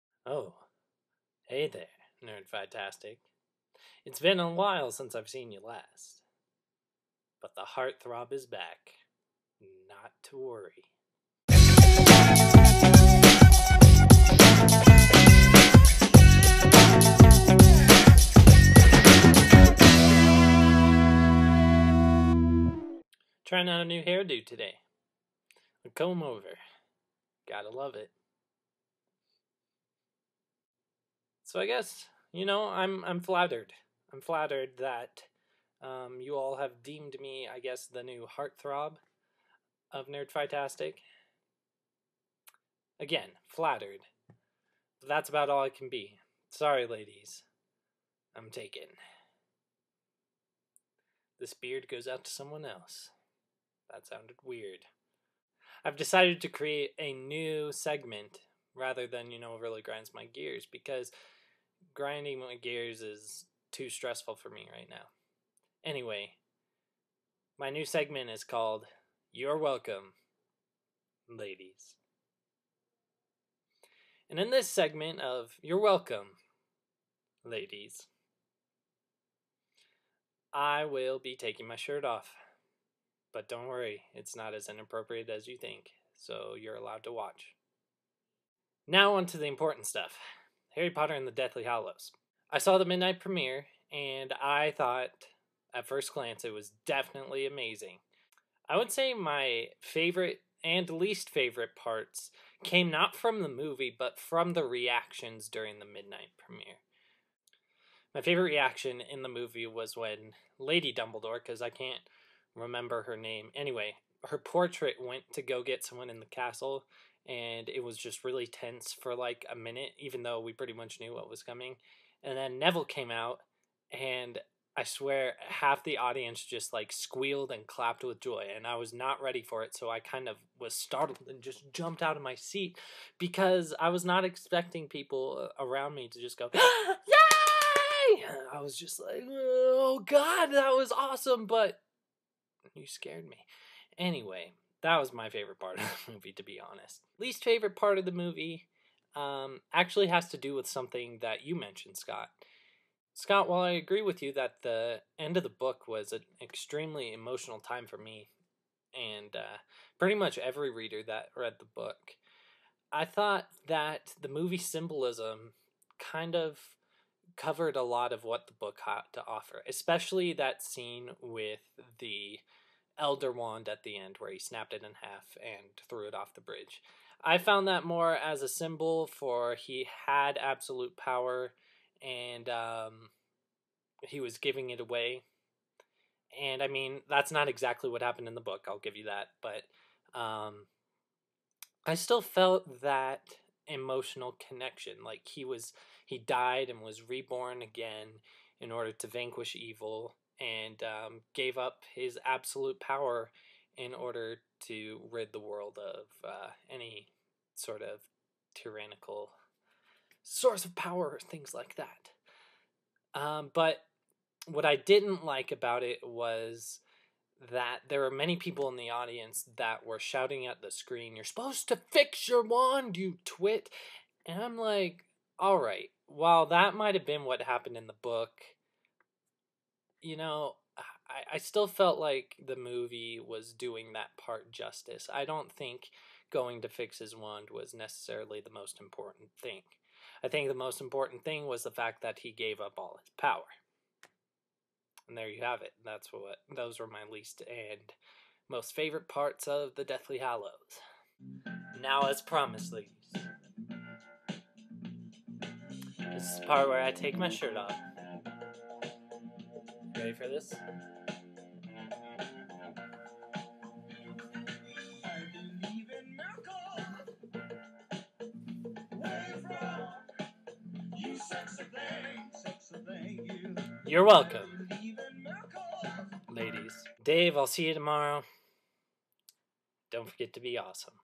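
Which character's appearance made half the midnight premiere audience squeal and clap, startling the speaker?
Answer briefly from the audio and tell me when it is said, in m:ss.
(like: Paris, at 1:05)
Neville, at 2:02.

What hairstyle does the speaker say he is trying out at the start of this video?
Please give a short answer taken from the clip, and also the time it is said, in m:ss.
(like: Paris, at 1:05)
A comb over, at 0:25.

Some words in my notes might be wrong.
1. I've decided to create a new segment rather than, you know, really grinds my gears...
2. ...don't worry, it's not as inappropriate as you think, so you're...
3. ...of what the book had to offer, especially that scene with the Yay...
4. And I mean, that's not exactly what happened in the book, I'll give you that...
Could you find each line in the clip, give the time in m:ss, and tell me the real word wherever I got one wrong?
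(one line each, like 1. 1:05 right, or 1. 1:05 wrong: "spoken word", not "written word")
1. 0:55 right
2. 1:23 right
3. 2:48 wrong: "Elder", not "Yay"
4. 3:06 right.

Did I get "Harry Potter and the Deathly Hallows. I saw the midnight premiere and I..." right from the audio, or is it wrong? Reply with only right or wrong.
right.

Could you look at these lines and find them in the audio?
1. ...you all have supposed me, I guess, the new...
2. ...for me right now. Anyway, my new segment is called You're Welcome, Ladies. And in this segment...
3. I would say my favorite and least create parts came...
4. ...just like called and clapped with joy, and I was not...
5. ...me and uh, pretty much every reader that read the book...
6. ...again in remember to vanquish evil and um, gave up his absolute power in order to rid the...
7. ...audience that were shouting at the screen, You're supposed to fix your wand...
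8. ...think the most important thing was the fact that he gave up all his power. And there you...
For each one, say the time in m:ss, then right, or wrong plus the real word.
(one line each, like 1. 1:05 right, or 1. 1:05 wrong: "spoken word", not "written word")
1. 0:36 wrong: "deemed", not "supposed"
2. 1:04 right
3. 1:38 wrong: "favorite", not "create"
4. 2:06 wrong: "squealed", not "called"
5. 2:37 right
6. 3:17 wrong: "order", not "remember"
7. 3:38 right
8. 4:00 right.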